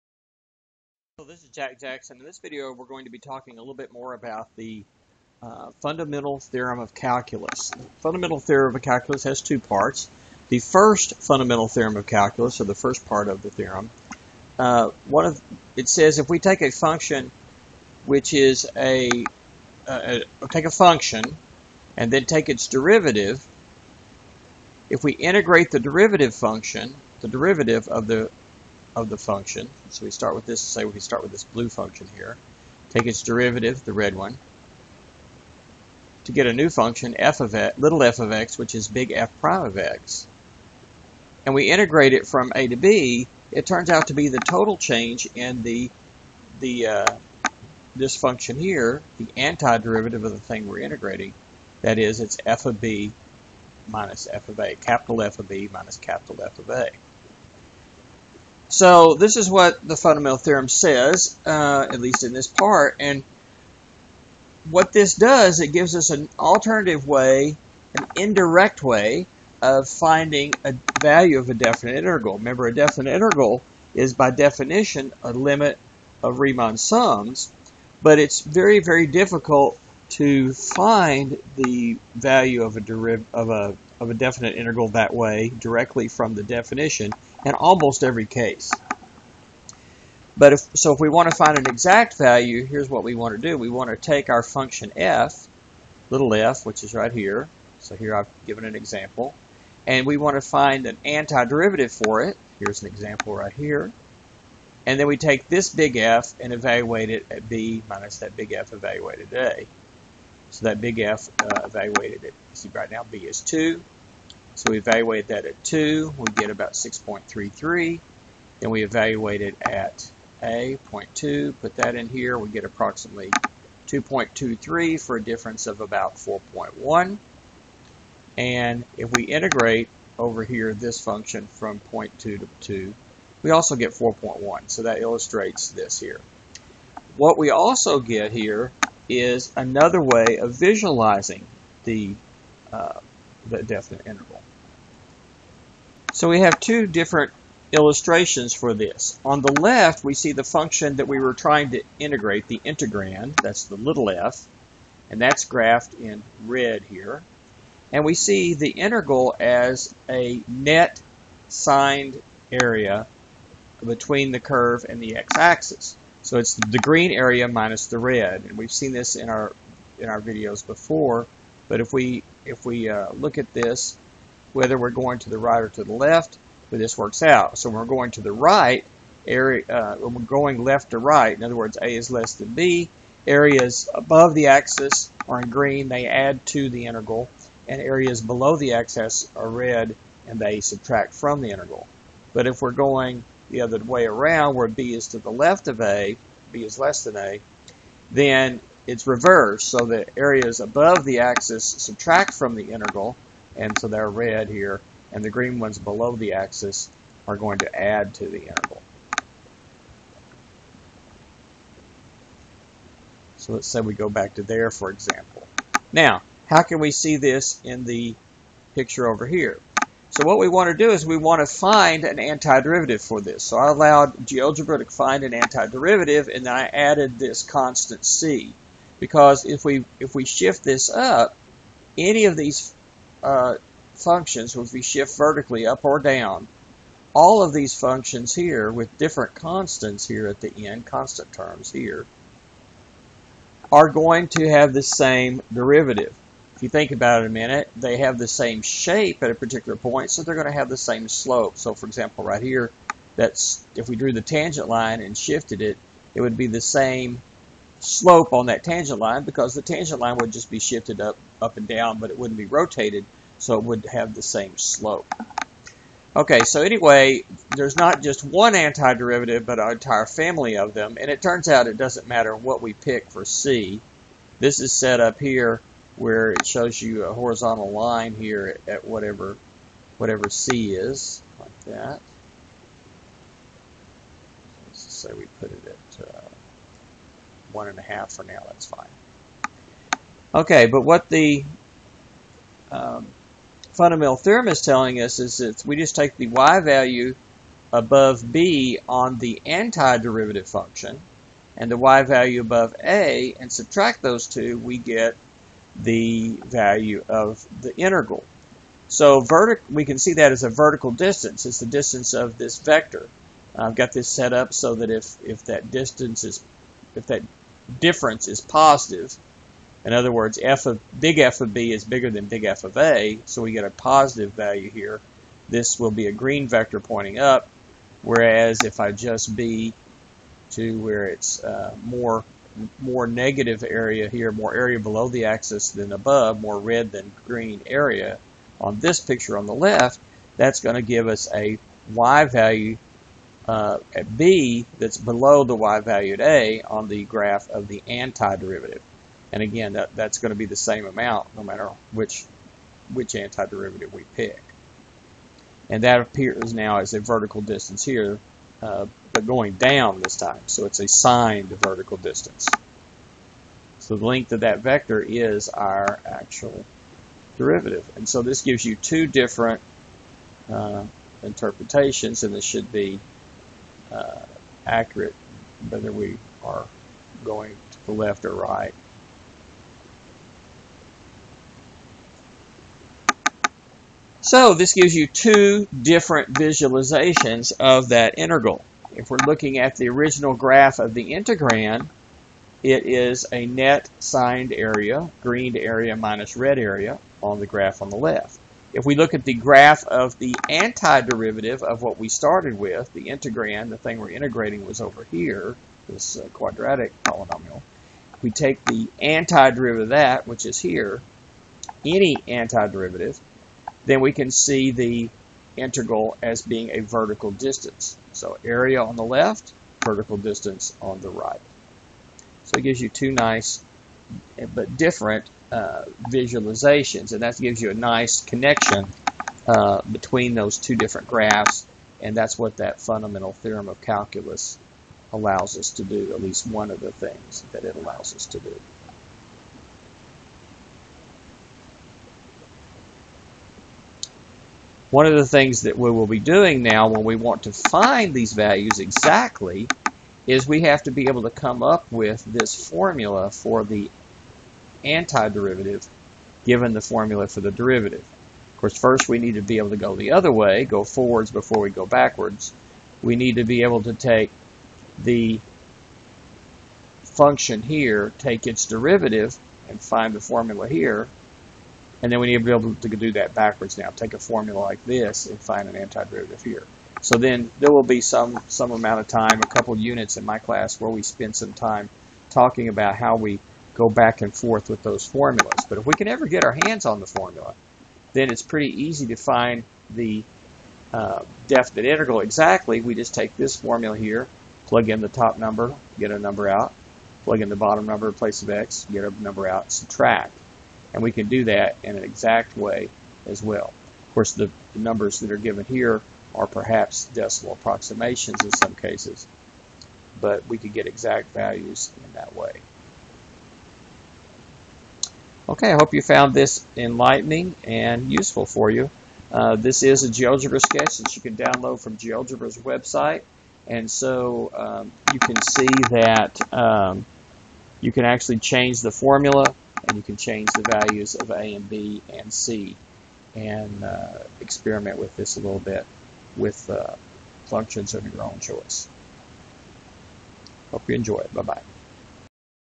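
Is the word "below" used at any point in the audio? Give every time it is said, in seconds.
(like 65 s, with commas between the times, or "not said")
188 s, 205 s, 334 s, 344 s.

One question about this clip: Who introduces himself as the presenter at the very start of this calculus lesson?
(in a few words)
Jack Jackson.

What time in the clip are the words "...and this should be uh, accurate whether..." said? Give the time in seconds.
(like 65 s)
372 s.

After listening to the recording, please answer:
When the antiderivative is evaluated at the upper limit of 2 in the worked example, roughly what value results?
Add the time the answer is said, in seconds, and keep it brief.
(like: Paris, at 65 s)
6.33, at 116 s.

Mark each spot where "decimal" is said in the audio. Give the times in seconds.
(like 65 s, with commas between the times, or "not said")
507 s.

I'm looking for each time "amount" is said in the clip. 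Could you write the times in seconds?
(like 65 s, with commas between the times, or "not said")
350 s, 478 s.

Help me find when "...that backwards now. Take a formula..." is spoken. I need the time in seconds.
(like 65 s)
473 s.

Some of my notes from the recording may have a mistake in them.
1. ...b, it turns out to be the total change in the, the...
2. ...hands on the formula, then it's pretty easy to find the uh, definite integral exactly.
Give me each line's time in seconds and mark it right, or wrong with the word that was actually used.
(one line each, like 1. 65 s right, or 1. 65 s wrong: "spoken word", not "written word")
1. 42 s right
2. 486 s right.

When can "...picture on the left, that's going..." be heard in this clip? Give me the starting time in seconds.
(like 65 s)
338 s.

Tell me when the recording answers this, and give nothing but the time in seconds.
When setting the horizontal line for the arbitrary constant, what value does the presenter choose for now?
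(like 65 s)
287 s.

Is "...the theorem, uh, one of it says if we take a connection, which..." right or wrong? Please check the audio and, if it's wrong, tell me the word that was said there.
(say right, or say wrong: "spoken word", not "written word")
wrong: "function", not "connection".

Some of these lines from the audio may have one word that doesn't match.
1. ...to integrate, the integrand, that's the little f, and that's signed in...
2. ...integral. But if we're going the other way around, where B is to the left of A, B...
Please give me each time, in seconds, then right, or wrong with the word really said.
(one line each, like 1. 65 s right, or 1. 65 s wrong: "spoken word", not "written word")
1. 151 s wrong: "graphed", not "signed"
2. 191 s right.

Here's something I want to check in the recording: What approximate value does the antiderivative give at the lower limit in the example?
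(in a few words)
2.23.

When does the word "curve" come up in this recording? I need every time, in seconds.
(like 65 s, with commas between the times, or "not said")
164 s.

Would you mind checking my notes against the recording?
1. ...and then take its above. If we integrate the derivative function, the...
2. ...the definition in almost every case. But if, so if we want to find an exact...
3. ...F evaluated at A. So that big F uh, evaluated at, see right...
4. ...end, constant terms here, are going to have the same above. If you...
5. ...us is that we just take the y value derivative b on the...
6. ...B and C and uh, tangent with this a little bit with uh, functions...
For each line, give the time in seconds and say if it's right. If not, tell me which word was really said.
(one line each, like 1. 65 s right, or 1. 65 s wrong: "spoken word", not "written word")
1. 21 s wrong: "derivative", not "above"
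2. 86 s right
3. 108 s right
4. 240 s wrong: "derivative", not "above"
5. 295 s wrong: "above", not "derivative"
6. 531 s wrong: "experiment", not "tangent".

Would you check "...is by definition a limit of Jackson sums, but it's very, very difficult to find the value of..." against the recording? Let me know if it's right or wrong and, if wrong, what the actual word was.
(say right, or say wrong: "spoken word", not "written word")
wrong: "Riemann", not "Jackson".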